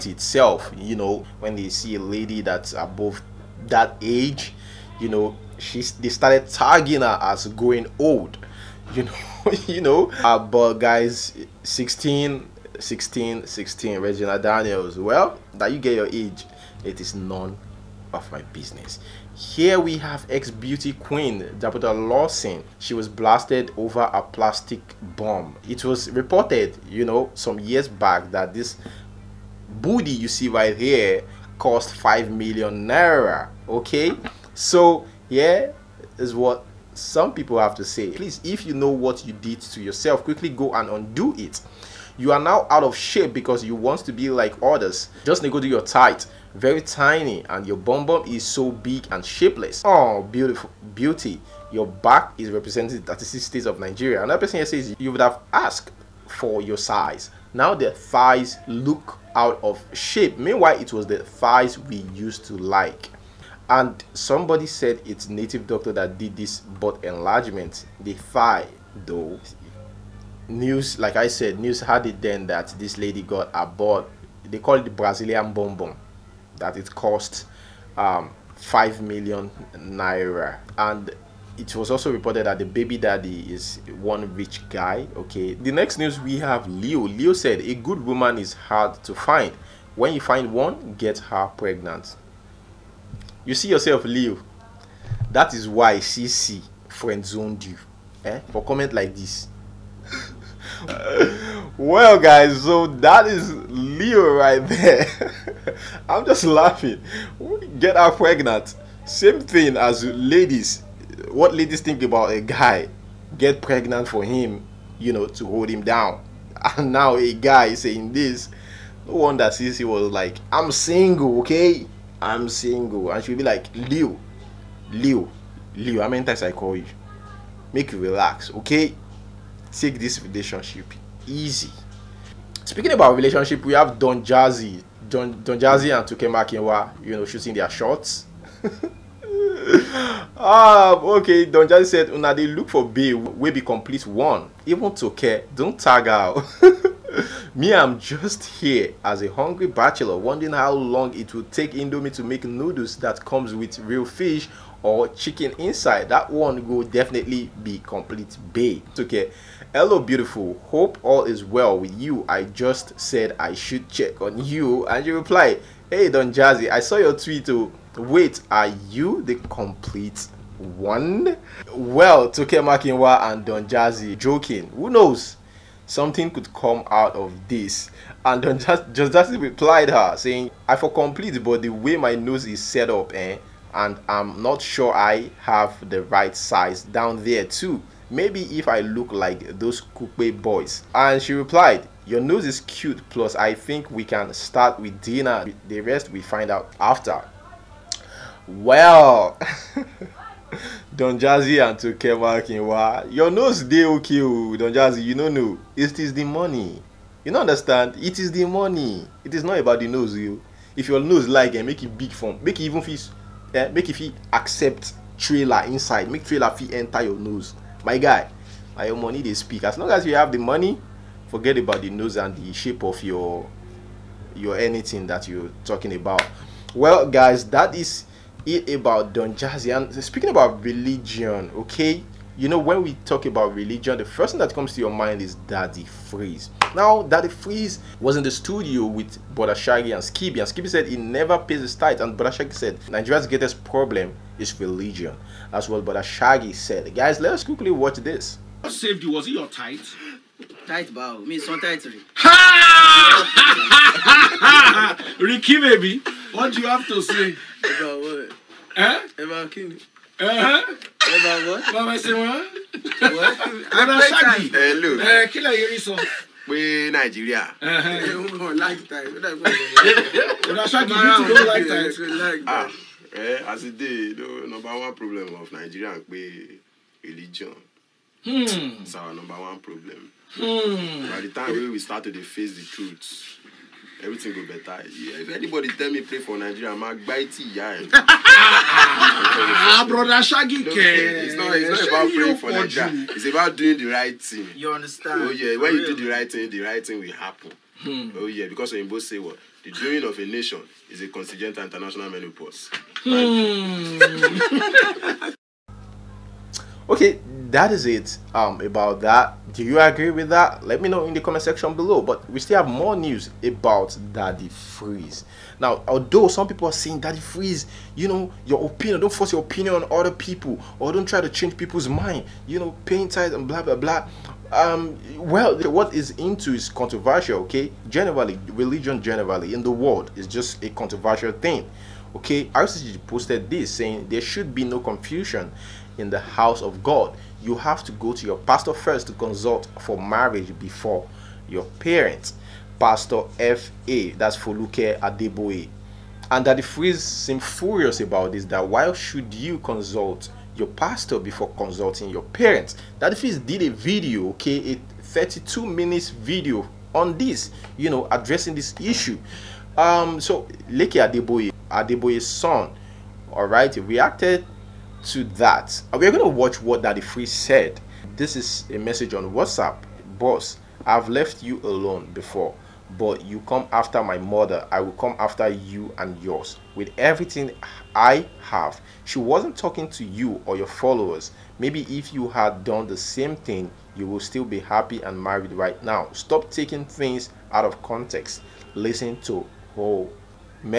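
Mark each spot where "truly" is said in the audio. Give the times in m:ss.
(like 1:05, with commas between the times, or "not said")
not said.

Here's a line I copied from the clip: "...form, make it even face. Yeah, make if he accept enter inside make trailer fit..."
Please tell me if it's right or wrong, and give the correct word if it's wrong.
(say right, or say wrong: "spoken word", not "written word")
wrong: "trailer", not "enter".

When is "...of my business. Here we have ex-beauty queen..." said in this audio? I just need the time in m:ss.
0:18.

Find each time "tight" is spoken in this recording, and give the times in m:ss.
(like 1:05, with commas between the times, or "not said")
0:45.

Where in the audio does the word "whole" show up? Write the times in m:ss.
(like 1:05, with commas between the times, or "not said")
6:29.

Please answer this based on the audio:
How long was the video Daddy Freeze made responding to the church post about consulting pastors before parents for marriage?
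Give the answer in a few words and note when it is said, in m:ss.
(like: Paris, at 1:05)
32 minutes, at 5:55.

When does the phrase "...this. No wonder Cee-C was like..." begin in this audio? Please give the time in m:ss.
1:58.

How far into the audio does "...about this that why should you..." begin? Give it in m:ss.
5:48.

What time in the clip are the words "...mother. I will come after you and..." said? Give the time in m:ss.
6:14.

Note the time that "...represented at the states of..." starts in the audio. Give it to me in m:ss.
0:52.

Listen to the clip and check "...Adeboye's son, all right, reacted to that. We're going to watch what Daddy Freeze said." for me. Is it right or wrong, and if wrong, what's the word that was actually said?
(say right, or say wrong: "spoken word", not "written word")
right.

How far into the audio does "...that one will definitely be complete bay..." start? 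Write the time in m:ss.
2:36.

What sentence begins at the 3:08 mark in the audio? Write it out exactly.
Maybe if I look like those coupe boys.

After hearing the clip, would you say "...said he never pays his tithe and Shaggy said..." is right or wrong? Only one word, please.
right.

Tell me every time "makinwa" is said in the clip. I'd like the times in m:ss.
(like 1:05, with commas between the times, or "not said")
2:16, 2:52, 3:22.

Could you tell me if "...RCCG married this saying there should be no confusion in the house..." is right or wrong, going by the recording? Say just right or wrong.
wrong.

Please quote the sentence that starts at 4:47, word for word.
ah brother shaggy kẹ it's not it's not about playing for nigeria it's about doing the right thing.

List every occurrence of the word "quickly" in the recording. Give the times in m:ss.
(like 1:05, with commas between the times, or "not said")
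0:40, 4:07.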